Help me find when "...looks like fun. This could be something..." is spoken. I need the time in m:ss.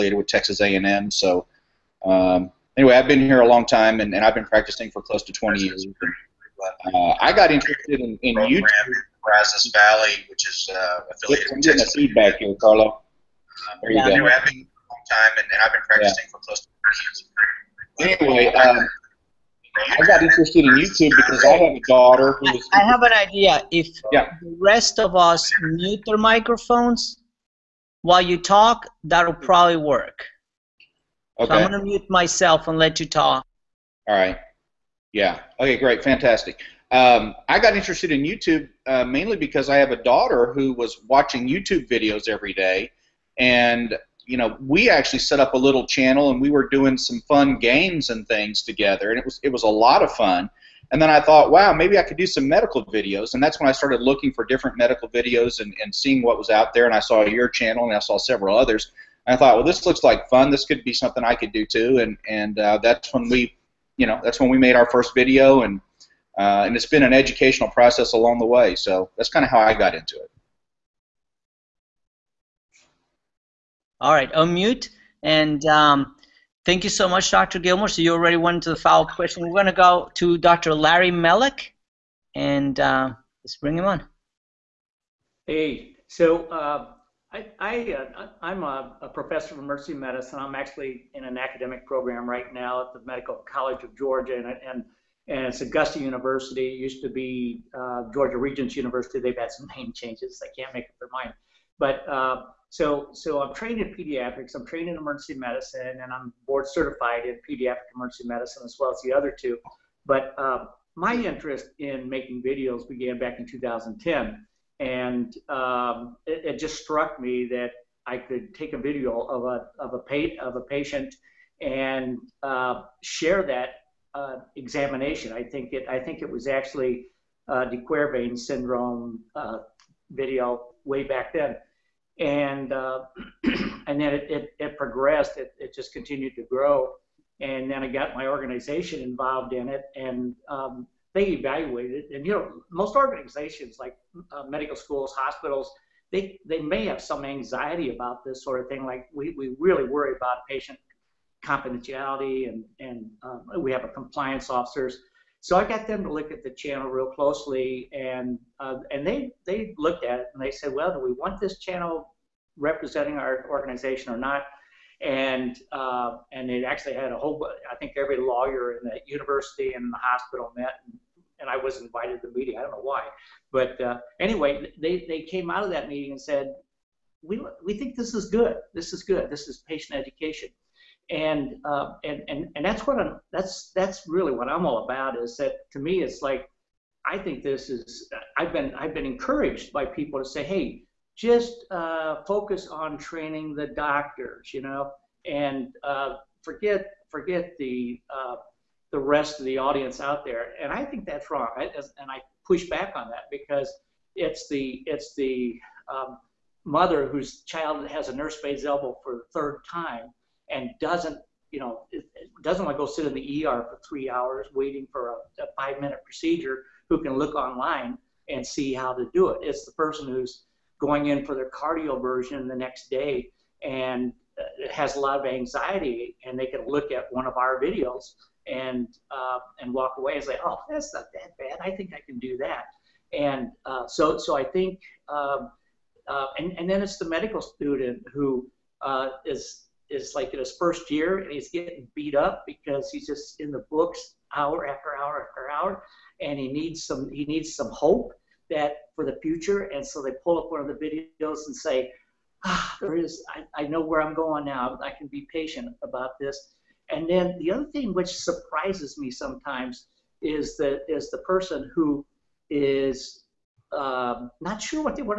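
0:59.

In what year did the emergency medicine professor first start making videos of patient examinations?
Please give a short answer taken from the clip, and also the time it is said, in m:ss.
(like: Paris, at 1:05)
2010, at 1:53.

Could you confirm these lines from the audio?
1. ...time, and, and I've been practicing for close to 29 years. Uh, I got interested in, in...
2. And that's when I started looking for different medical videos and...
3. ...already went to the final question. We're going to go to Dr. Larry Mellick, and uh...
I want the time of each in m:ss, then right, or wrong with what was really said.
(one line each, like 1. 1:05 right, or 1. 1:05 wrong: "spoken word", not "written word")
1. 0:03 wrong: "20", not "29"
2. 0:53 right
3. 1:18 right.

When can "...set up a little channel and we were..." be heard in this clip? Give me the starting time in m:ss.
0:45.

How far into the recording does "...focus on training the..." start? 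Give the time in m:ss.
3:12.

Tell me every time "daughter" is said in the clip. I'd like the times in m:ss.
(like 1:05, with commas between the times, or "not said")
0:21, 0:40.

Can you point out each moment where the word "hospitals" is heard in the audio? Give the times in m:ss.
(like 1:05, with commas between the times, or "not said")
2:25, 2:50.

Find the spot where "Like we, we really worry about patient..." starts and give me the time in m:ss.
2:28.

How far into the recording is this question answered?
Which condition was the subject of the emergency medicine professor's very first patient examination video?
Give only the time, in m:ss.
2:07.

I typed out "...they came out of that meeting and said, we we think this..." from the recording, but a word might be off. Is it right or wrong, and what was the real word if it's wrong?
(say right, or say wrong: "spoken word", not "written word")
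right.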